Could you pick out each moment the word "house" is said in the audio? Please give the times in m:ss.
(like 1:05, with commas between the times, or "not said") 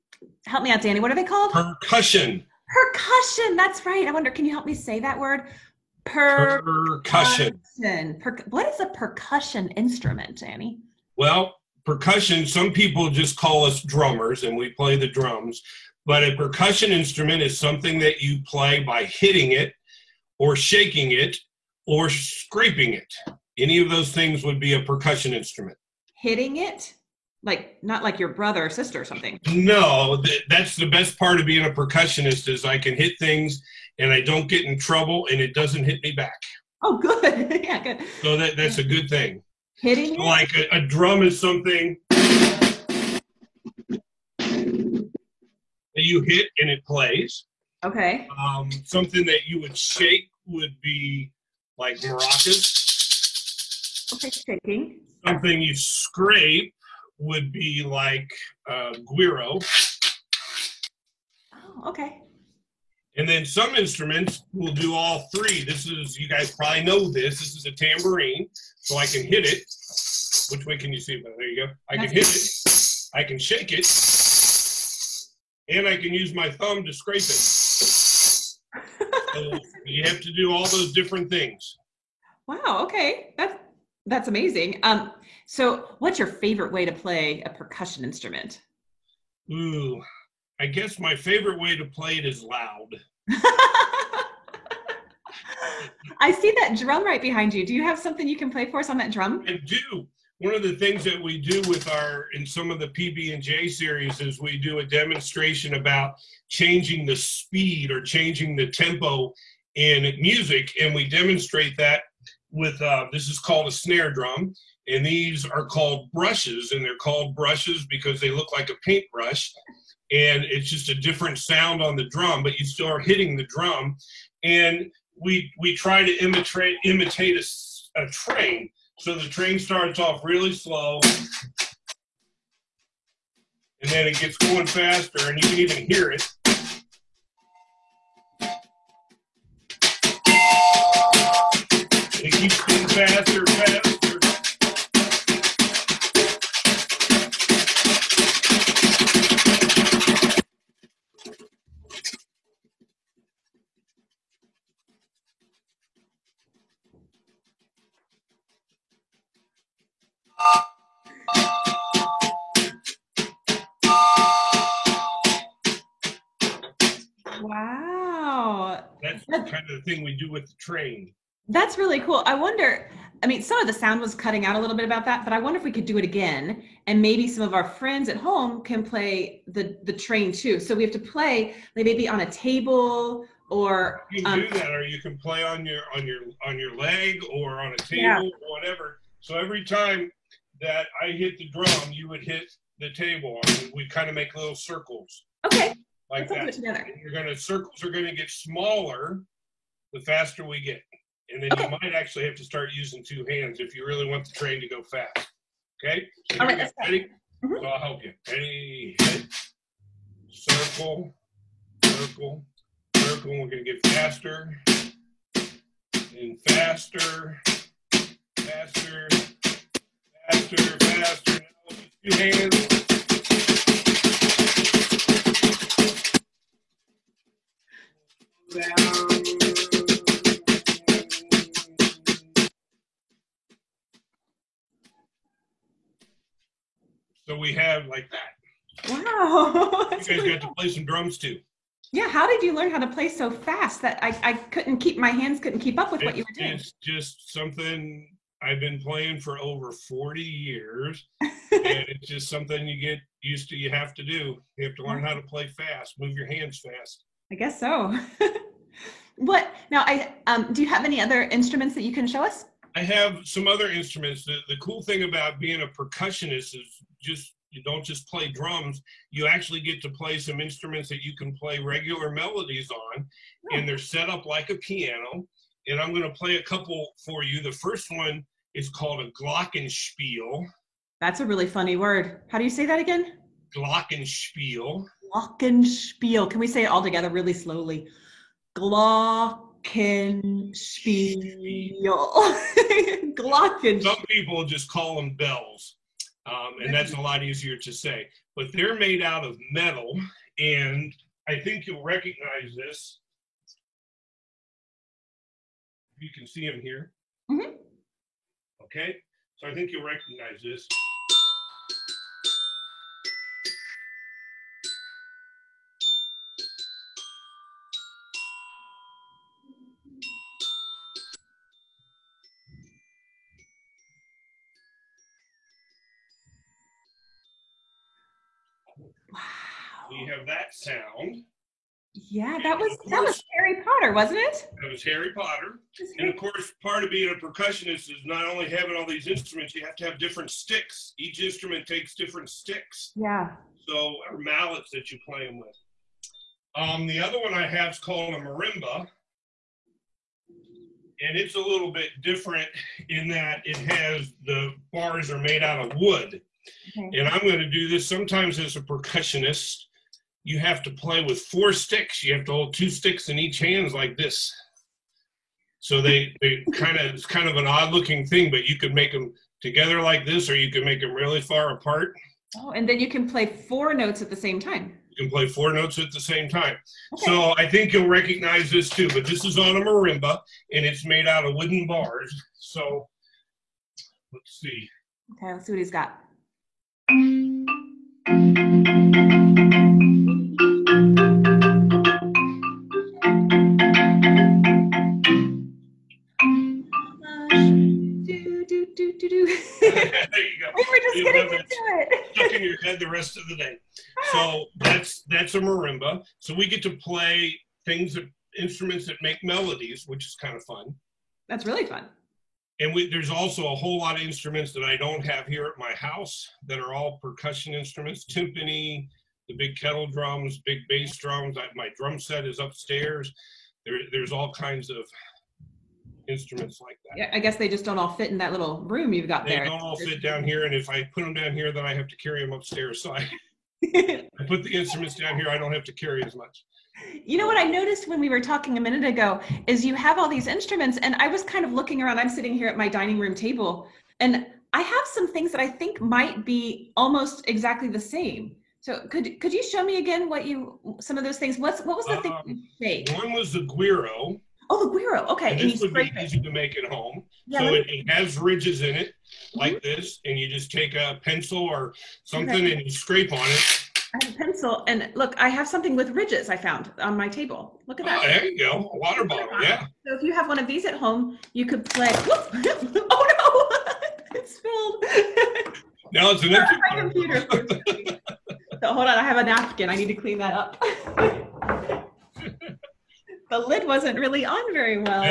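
6:55.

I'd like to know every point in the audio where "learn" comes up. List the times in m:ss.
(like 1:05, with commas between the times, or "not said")
4:02, 4:14.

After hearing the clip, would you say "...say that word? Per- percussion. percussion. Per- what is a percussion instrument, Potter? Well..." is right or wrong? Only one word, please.
wrong.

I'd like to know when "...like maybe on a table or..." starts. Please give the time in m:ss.
3:01.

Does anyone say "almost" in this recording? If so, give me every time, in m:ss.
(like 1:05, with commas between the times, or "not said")
7:26.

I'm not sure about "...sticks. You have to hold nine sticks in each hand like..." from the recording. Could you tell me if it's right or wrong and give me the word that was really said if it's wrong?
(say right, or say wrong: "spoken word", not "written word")
wrong: "two", not "nine".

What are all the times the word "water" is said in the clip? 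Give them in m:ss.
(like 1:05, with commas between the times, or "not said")
7:48.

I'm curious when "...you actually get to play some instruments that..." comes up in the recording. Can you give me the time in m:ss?
4:29.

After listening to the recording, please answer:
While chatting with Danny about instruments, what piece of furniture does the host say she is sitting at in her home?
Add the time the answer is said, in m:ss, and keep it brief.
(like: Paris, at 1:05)
Dining room table, at 7:22.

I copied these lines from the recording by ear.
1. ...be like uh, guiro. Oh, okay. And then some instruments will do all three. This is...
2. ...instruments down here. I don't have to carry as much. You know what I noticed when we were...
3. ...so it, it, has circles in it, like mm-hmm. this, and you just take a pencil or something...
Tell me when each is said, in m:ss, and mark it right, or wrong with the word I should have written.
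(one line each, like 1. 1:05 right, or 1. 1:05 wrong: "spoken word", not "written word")
1. 0:57 right
2. 7:14 right
3. 7:37 wrong: "ridges", not "circles".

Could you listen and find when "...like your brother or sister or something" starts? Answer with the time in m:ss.
0:28.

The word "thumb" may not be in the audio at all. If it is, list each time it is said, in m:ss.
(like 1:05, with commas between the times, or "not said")
1:16.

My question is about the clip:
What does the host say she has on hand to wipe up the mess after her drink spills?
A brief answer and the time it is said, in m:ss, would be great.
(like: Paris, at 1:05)
A napkin, at 7:59.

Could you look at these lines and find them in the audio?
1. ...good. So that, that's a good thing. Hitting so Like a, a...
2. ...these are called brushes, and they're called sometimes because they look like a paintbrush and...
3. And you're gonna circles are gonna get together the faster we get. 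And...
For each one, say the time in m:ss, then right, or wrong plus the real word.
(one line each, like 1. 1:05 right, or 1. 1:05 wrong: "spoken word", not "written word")
1. 0:37 right
2. 1:55 wrong: "brushes", not "sometimes"
3. 3:16 wrong: "smaller", not "together".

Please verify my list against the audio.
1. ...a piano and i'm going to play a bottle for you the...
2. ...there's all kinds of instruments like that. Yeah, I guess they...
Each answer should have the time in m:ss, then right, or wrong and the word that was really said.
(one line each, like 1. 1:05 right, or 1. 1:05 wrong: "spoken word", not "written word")
1. 4:34 wrong: "couple", not "bottle"
2. 7:03 right.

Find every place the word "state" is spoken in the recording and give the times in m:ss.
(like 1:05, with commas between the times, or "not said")
not said.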